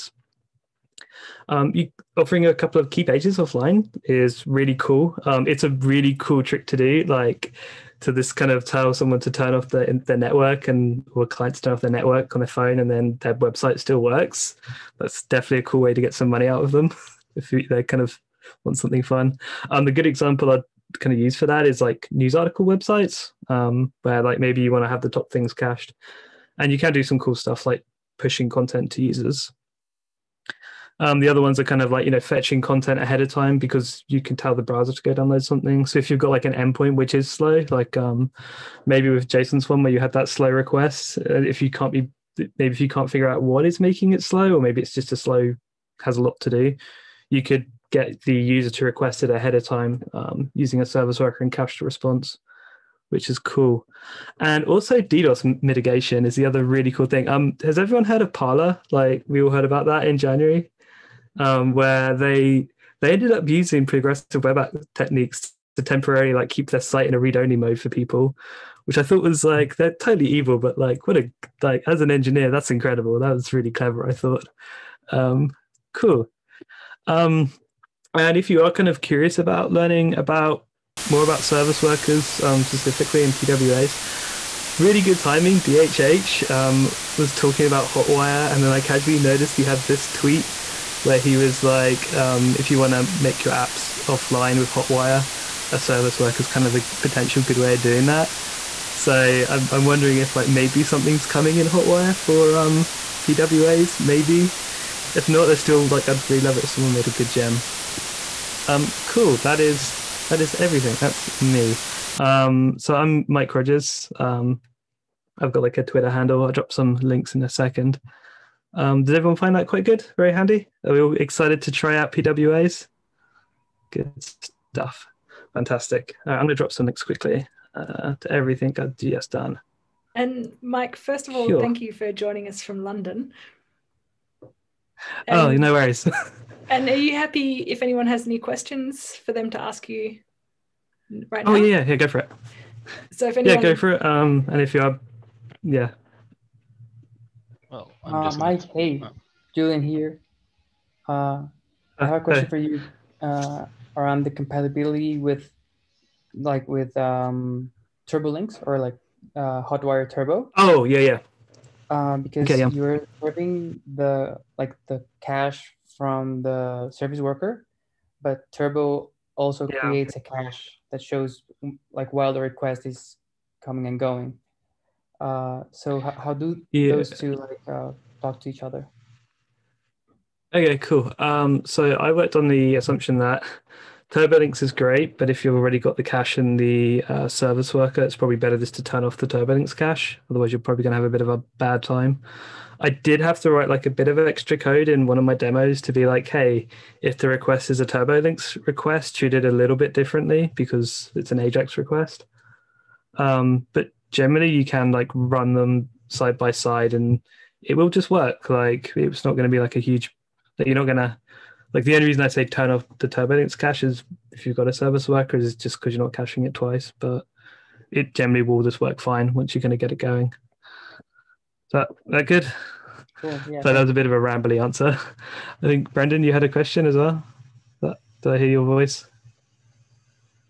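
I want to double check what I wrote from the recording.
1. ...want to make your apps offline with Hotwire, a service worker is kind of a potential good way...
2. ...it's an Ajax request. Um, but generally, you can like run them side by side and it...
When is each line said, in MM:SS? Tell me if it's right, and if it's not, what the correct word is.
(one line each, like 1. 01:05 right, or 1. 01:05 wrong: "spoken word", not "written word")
1. 01:32 right
2. 03:21 right.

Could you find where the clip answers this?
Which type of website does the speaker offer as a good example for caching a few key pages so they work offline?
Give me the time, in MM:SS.
00:22.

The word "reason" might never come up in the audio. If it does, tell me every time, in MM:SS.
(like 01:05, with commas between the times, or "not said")
03:32.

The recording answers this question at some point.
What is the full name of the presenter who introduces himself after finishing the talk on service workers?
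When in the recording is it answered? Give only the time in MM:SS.
01:53.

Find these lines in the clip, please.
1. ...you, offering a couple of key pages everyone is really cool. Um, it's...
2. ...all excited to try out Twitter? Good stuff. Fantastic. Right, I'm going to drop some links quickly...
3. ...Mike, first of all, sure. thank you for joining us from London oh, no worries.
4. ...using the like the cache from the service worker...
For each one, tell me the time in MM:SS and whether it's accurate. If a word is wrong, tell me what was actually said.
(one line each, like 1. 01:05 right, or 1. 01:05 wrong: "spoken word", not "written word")
1. 00:01 wrong: "offline", not "everyone"
2. 02:00 wrong: "PWAs", not "Twitter"
3. 02:10 right
4. 02:43 wrong: "serving", not "using".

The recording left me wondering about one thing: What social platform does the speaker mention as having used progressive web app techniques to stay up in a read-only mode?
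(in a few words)
Parler.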